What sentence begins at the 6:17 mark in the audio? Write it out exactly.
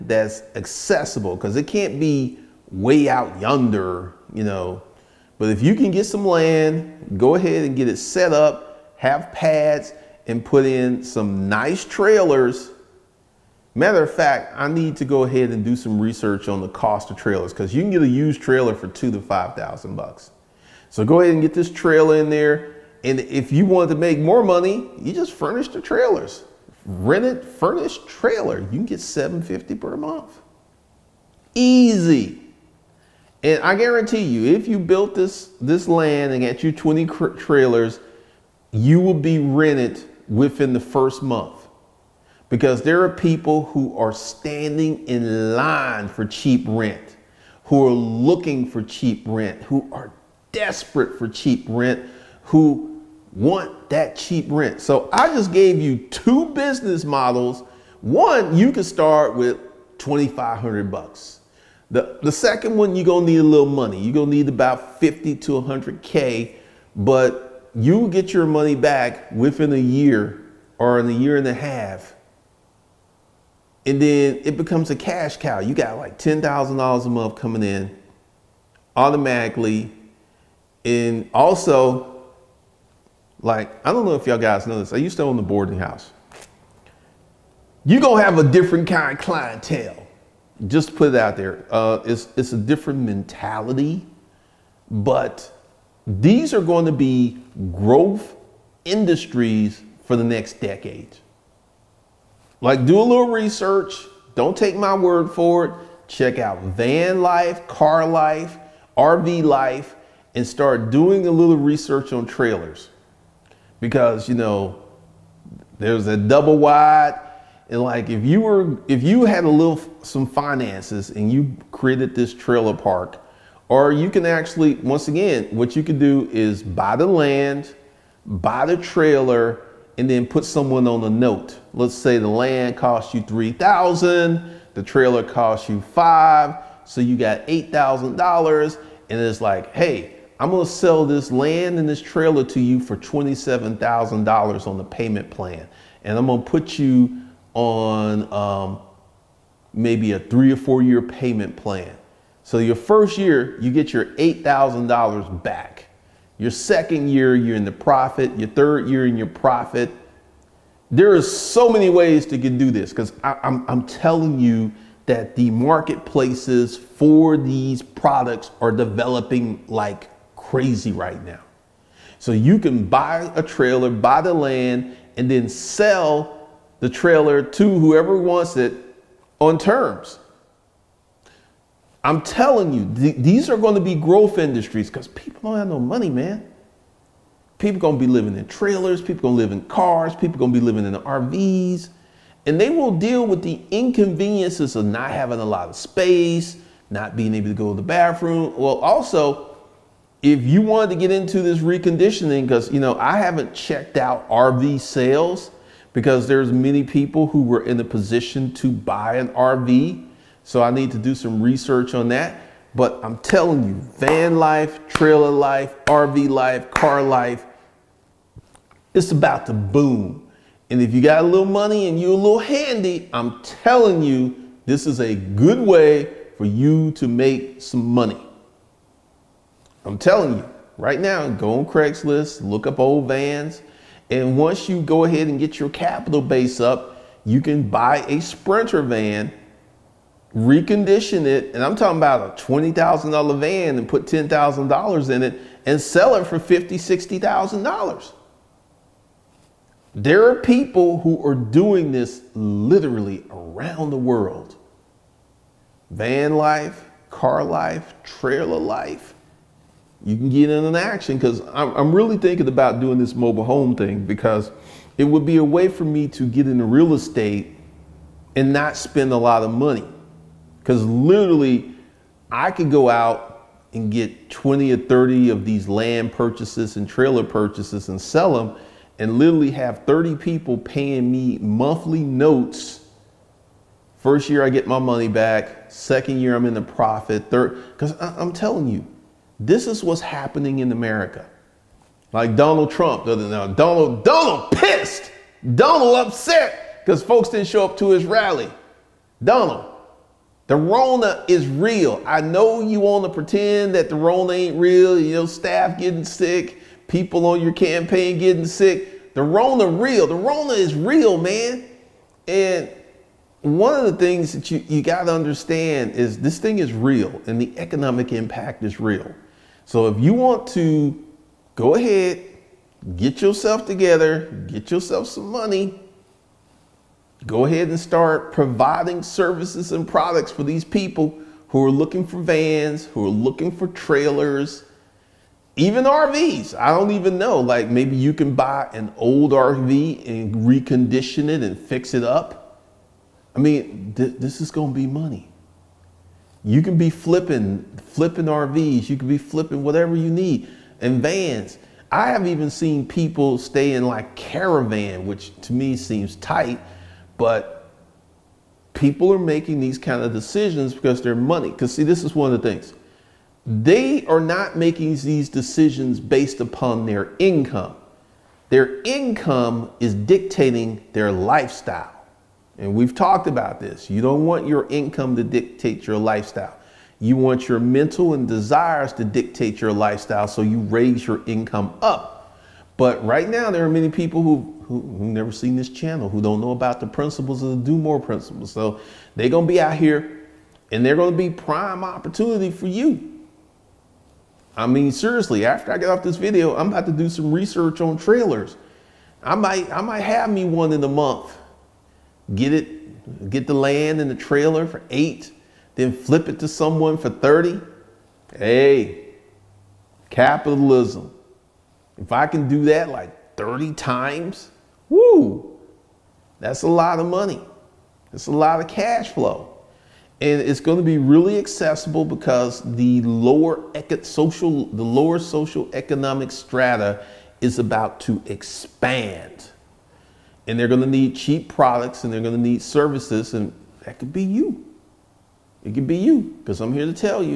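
You want your mental and desires to dictate your lifestyle, so you raise your income up.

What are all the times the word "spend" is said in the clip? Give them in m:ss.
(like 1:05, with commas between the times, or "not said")
4:28.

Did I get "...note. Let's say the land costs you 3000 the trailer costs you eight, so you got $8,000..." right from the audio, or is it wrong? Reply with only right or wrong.
wrong.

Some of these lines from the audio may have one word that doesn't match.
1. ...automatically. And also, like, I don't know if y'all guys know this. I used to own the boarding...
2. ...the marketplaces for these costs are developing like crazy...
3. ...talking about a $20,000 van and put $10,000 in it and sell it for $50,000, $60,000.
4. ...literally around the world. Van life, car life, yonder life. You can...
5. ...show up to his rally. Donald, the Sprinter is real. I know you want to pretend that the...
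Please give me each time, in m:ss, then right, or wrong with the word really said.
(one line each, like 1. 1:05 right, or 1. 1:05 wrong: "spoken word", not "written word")
1. 1:18 right
2. 2:45 wrong: "products", not "costs"
3. 4:01 right
4. 4:12 wrong: "trailer", not "yonder"
5. 4:57 wrong: "Rona", not "Sprinter".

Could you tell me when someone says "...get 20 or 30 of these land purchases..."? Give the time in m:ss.
4:33.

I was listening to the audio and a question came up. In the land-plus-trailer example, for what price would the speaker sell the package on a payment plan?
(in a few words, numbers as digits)
$27,000.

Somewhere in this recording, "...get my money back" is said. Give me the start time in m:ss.
4:44.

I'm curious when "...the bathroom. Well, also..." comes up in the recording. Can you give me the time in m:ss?
3:17.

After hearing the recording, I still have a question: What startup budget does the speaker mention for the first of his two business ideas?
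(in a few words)
$2,500.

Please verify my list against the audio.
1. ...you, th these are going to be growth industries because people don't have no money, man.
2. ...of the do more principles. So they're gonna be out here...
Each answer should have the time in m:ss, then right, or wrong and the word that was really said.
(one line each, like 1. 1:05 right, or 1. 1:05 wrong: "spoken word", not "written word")
1. 3:02 right
2. 6:27 right.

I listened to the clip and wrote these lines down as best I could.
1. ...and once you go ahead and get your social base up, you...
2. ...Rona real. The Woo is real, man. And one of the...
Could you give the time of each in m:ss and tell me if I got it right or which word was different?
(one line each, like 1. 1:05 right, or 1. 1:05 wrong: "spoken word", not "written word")
1. 3:54 wrong: "capital", not "social"
2. 5:09 wrong: "Rona", not "Woo".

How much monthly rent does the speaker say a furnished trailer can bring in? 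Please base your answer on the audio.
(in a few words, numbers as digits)
$750.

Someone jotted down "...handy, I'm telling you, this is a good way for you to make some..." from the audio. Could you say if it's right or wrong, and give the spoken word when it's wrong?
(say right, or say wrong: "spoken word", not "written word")
right.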